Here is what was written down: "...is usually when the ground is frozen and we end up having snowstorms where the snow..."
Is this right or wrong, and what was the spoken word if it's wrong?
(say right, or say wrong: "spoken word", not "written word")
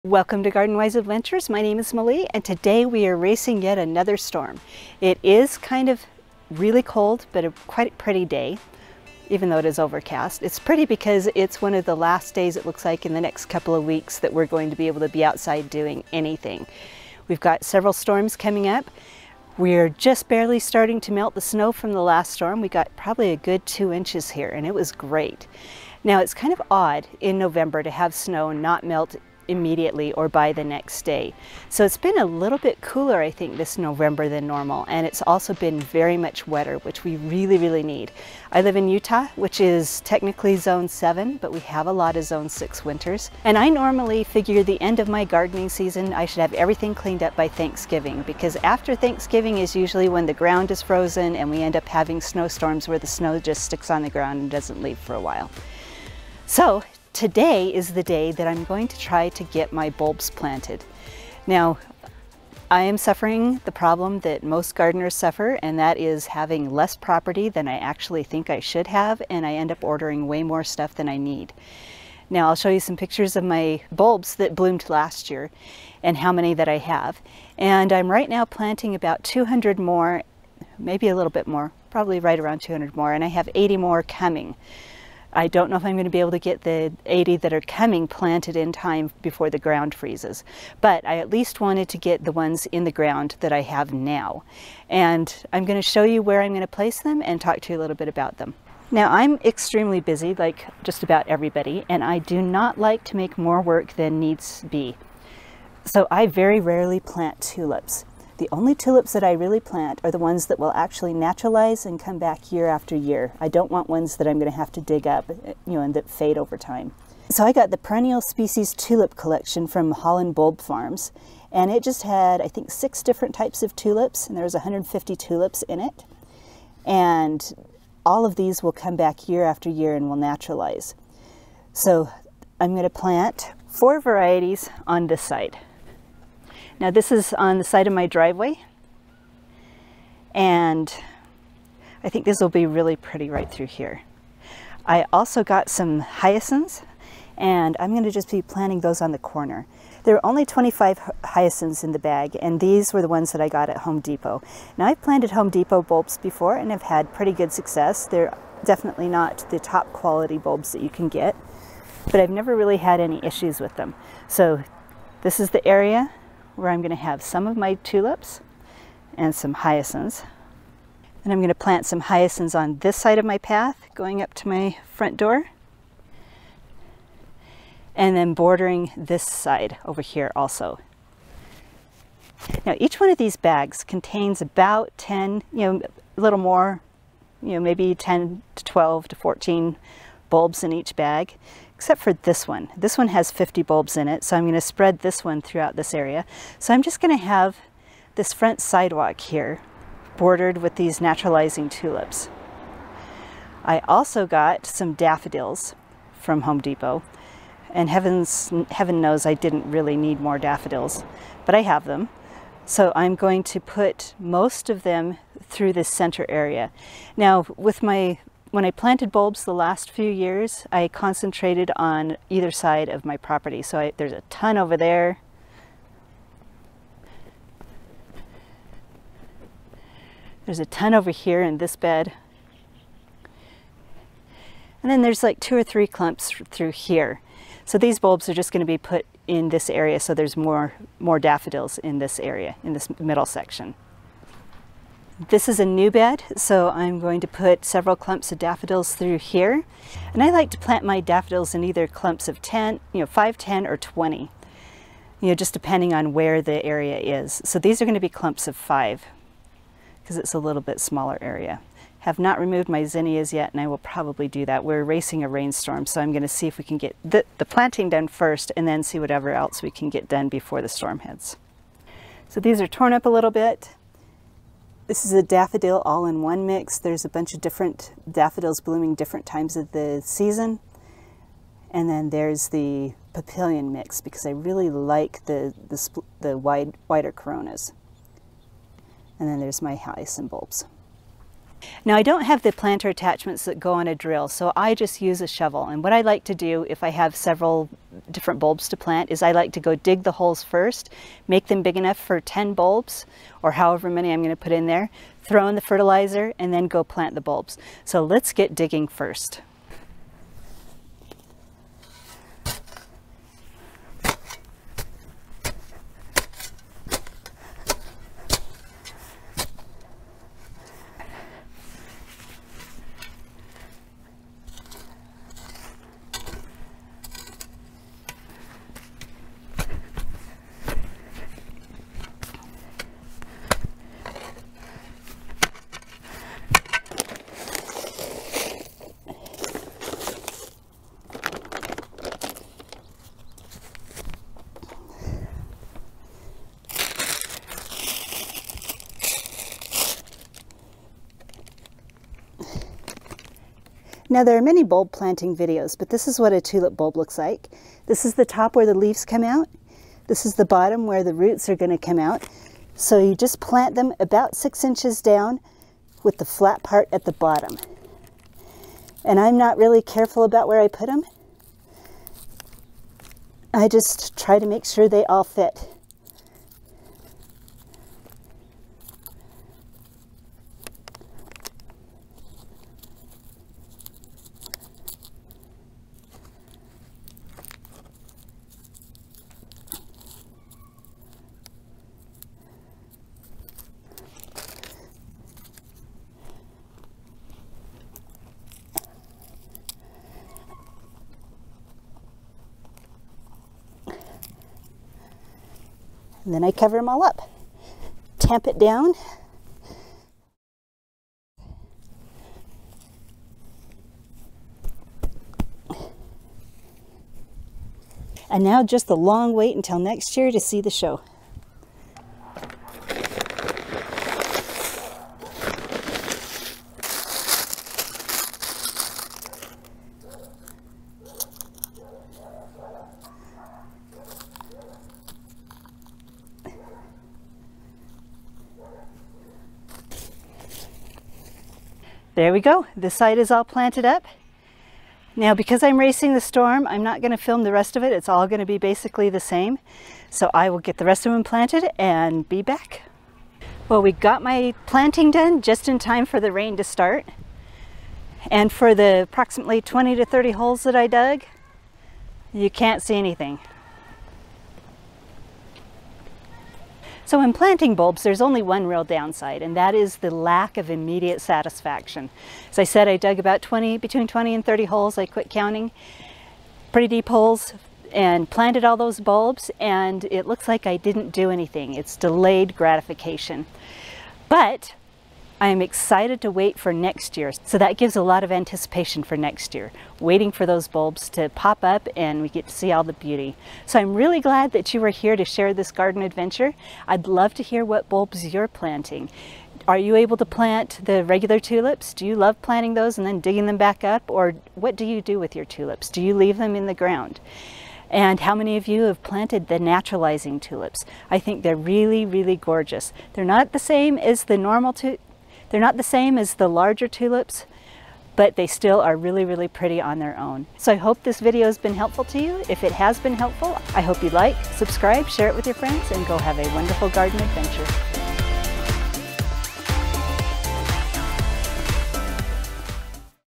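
right.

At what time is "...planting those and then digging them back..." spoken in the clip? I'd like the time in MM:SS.
08:22.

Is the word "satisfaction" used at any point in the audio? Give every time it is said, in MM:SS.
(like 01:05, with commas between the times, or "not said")
07:51.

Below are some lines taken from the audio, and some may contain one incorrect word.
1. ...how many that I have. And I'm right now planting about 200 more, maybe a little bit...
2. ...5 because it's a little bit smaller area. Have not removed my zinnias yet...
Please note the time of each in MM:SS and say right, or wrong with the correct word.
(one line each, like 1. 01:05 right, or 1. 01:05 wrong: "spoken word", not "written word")
1. 01:16 right
2. 04:18 right.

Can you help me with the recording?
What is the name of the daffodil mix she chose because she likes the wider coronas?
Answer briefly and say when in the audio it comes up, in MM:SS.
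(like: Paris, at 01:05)
papillion mix, at 04:43.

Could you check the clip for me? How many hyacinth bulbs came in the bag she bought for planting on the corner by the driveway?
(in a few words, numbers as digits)
25.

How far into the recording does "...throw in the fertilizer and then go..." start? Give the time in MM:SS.
05:05.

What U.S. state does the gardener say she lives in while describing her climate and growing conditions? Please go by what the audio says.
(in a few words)
Utah.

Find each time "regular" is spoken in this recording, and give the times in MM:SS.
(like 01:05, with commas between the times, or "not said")
08:21.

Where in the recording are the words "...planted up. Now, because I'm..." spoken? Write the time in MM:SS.
07:23.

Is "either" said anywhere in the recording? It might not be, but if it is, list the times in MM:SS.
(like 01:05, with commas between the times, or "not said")
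03:42, 04:11.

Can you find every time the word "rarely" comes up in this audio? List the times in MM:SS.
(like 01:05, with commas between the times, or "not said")
01:46.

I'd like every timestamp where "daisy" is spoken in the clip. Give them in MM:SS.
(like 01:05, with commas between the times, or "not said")
not said.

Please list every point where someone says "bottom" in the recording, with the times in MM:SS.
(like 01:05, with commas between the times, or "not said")
06:00, 06:07.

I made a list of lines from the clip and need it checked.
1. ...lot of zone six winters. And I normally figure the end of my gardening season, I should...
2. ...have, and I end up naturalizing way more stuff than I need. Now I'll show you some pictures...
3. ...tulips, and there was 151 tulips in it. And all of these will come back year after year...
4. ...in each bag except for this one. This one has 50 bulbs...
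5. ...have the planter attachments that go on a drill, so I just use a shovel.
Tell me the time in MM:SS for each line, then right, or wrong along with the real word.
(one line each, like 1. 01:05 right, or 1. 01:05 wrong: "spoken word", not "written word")
1. 00:41 right
2. 01:08 wrong: "ordering", not "naturalizing"
3. 02:03 wrong: "150", not "151"
4. 03:10 right
5. 04:52 right.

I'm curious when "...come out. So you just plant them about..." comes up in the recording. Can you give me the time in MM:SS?
06:01.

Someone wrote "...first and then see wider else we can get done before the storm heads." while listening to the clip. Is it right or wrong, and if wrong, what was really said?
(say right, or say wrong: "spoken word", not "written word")
wrong: "whatever", not "wider".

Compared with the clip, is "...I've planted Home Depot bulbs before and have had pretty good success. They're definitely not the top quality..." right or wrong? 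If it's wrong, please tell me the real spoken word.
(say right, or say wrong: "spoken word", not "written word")
right.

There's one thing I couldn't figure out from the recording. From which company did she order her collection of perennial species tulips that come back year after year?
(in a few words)
Holland Bulb Farms.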